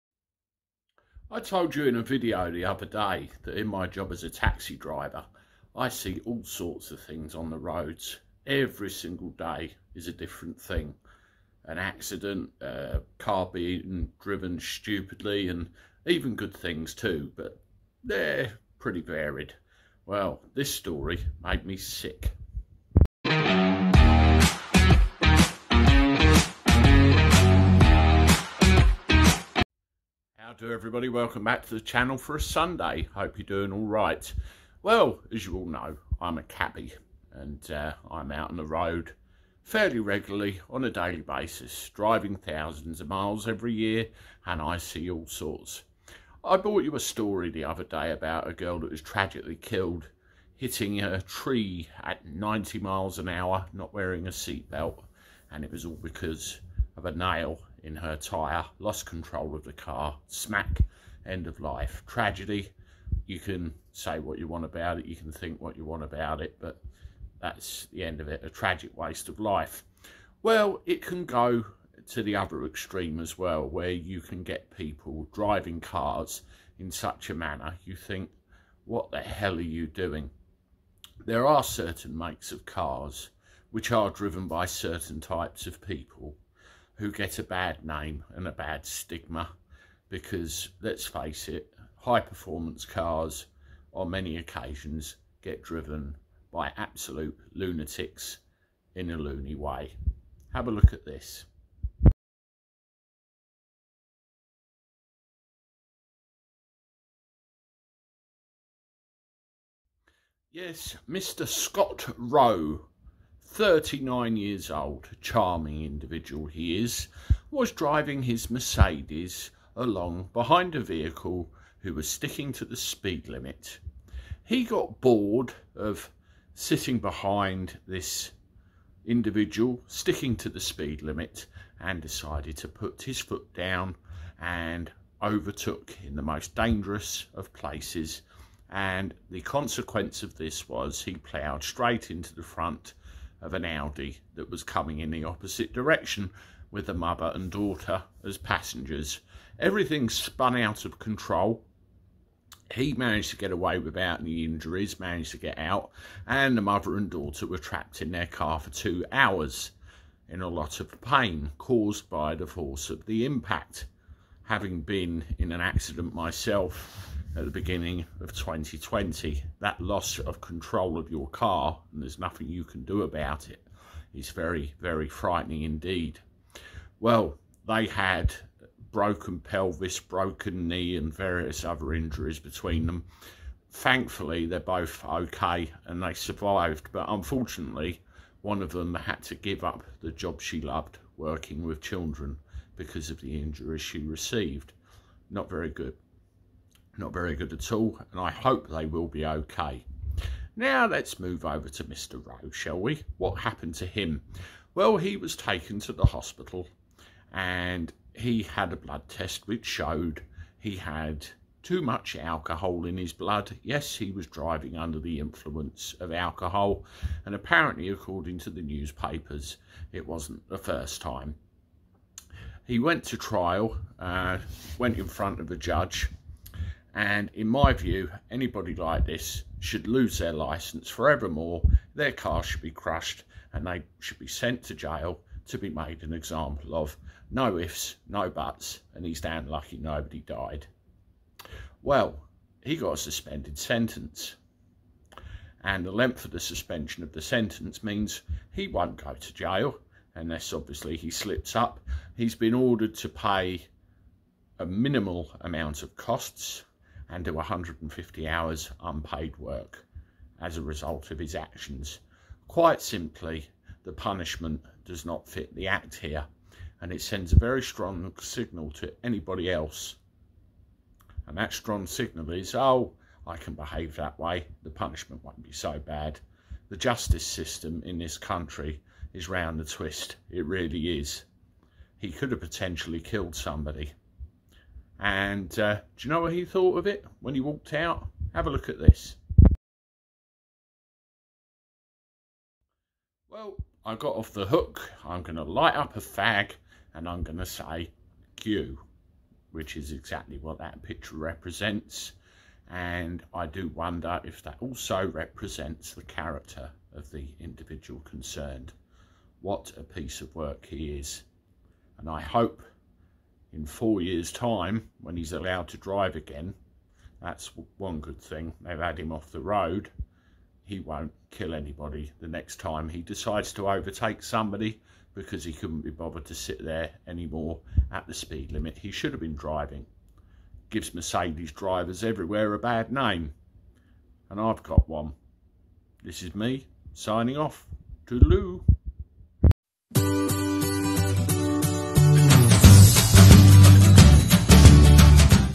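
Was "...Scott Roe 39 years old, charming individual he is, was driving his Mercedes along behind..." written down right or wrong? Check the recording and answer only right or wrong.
right.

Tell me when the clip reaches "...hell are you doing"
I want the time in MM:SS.
01:19.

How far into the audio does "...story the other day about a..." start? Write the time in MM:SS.
00:46.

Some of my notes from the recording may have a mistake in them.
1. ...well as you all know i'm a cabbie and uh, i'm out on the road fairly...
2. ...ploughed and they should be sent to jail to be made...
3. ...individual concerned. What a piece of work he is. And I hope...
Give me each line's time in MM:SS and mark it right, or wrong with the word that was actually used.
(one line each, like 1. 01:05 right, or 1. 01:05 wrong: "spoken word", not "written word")
1. 00:34 right
2. 03:52 wrong: "crushed", not "ploughed"
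3. 05:07 right.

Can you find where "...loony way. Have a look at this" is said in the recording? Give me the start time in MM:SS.
01:39.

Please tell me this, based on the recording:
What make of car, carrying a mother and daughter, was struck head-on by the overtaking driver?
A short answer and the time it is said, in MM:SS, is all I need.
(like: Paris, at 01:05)
Audi, at 02:23.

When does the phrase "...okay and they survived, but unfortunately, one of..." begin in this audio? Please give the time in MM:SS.
03:05.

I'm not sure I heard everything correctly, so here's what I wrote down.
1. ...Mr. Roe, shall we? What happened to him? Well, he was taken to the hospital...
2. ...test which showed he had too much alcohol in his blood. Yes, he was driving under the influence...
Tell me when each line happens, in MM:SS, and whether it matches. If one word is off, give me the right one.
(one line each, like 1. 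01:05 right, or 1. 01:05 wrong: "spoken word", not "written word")
1. 03:21 right
2. 03:29 right.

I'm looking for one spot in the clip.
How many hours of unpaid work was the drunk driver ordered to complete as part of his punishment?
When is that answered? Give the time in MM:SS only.
04:17.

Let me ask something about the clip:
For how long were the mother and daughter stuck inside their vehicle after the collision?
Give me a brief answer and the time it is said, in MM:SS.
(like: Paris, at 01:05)
2 hours, at 02:38.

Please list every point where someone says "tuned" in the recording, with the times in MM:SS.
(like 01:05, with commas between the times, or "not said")
not said.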